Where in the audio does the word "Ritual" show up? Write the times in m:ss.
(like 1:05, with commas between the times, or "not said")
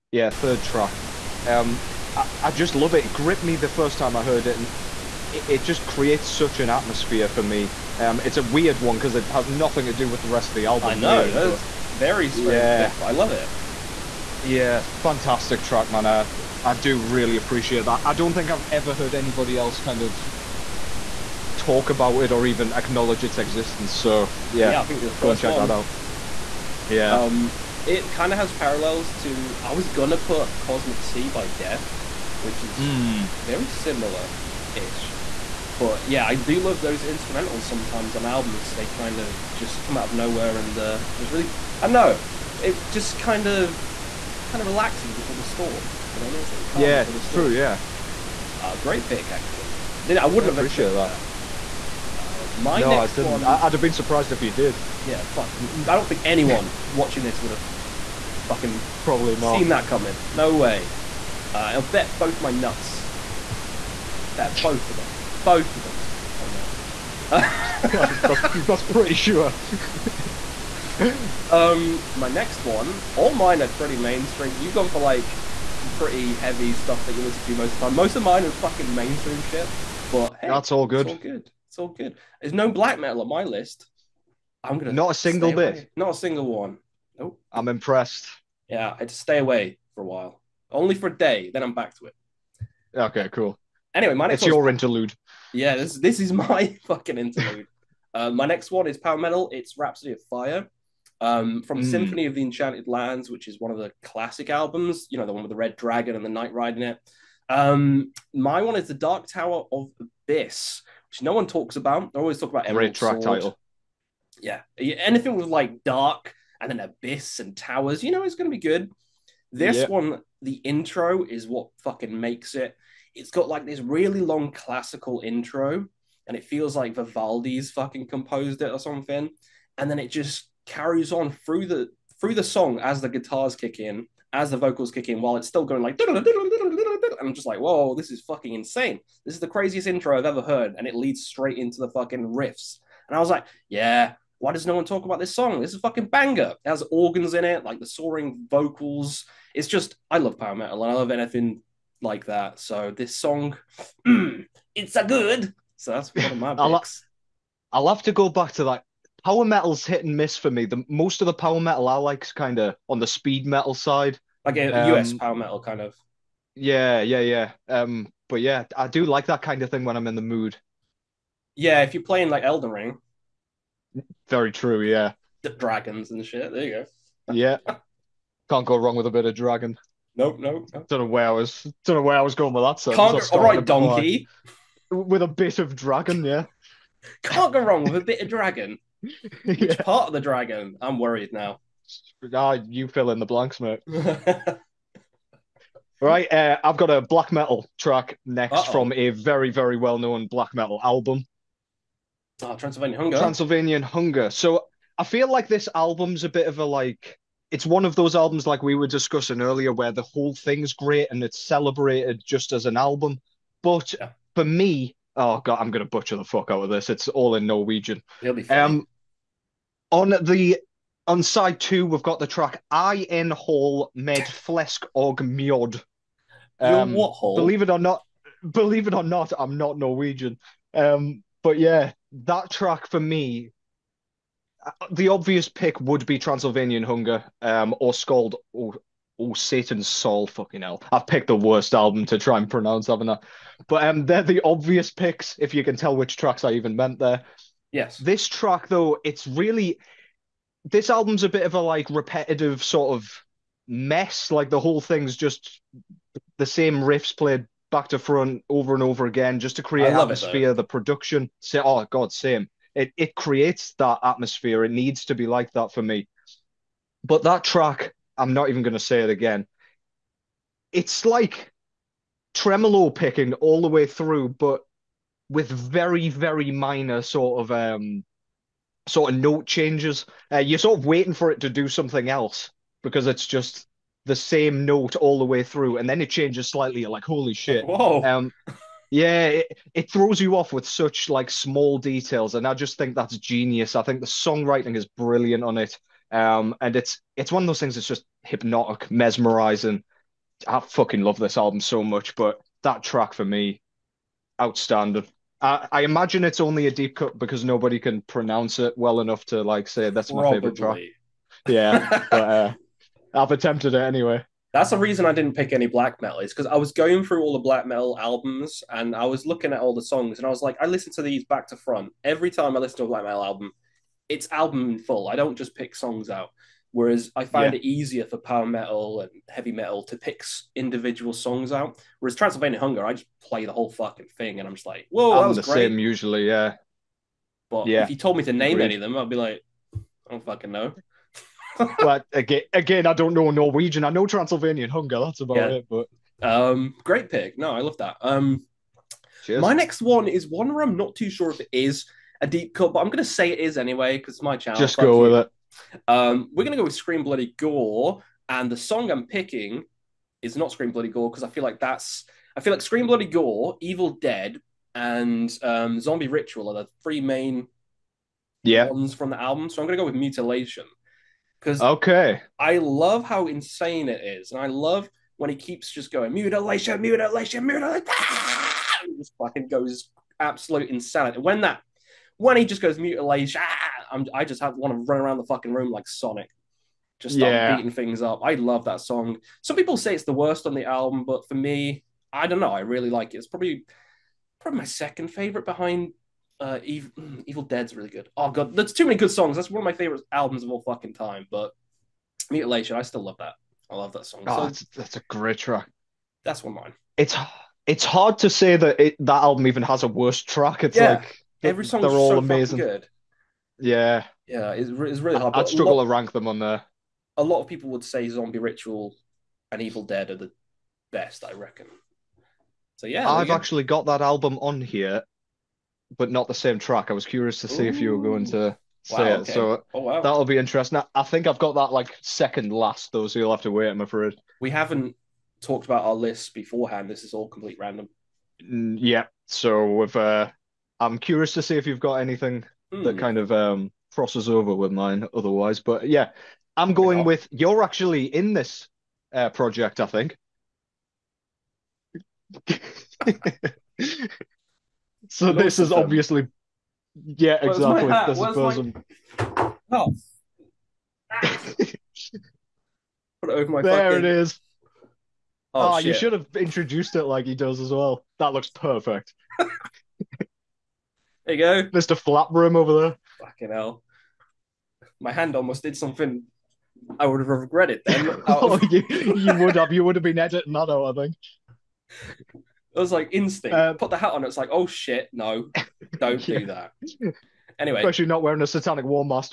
6:06, 6:58.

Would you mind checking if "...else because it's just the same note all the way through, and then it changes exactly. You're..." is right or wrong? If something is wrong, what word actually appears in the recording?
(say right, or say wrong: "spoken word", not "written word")
wrong: "slightly", not "exactly".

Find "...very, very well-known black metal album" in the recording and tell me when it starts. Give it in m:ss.
3:19.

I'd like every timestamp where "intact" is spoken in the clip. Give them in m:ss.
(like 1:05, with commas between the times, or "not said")
not said.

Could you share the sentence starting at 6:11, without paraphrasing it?
Because okay, I love how insane it is, and I love when he keeps just going mutilation, mutilation, mutilation.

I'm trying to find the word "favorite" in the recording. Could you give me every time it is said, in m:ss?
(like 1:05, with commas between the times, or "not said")
5:10, 6:35, 6:39.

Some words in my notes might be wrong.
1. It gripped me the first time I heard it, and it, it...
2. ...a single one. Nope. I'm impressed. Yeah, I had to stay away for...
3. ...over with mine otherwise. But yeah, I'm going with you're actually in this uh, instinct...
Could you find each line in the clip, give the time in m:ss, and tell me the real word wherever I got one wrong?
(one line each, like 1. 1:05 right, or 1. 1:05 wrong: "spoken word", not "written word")
1. 0:03 right
2. 1:26 right
3. 7:24 wrong: "project", not "instinct".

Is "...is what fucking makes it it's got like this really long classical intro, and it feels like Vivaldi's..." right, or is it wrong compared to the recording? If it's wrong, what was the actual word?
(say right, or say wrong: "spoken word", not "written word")
right.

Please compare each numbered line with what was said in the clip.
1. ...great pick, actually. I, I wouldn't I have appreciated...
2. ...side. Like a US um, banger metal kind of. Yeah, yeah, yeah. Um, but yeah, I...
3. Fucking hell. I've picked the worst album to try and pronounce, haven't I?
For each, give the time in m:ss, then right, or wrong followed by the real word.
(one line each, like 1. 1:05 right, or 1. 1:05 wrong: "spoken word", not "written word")
1. 0:48 right
2. 2:43 wrong: "power", not "banger"
3. 4:00 right.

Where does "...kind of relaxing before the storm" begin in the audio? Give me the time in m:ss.
0:44.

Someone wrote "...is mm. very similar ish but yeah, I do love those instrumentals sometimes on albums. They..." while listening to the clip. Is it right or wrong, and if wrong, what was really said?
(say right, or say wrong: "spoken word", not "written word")
right.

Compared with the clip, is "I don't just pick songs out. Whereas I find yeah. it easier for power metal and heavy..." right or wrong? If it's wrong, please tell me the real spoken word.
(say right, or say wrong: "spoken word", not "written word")
right.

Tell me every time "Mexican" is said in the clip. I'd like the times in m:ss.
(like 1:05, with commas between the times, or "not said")
not said.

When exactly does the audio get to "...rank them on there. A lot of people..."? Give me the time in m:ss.
6:55.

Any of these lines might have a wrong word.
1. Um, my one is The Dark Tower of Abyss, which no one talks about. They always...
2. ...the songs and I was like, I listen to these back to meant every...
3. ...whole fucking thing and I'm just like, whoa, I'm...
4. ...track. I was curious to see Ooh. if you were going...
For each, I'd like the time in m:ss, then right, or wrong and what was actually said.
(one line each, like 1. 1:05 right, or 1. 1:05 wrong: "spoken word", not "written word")
1. 1:47 right
2. 5:19 wrong: "front", not "meant"
3. 5:33 right
4. 7:06 right.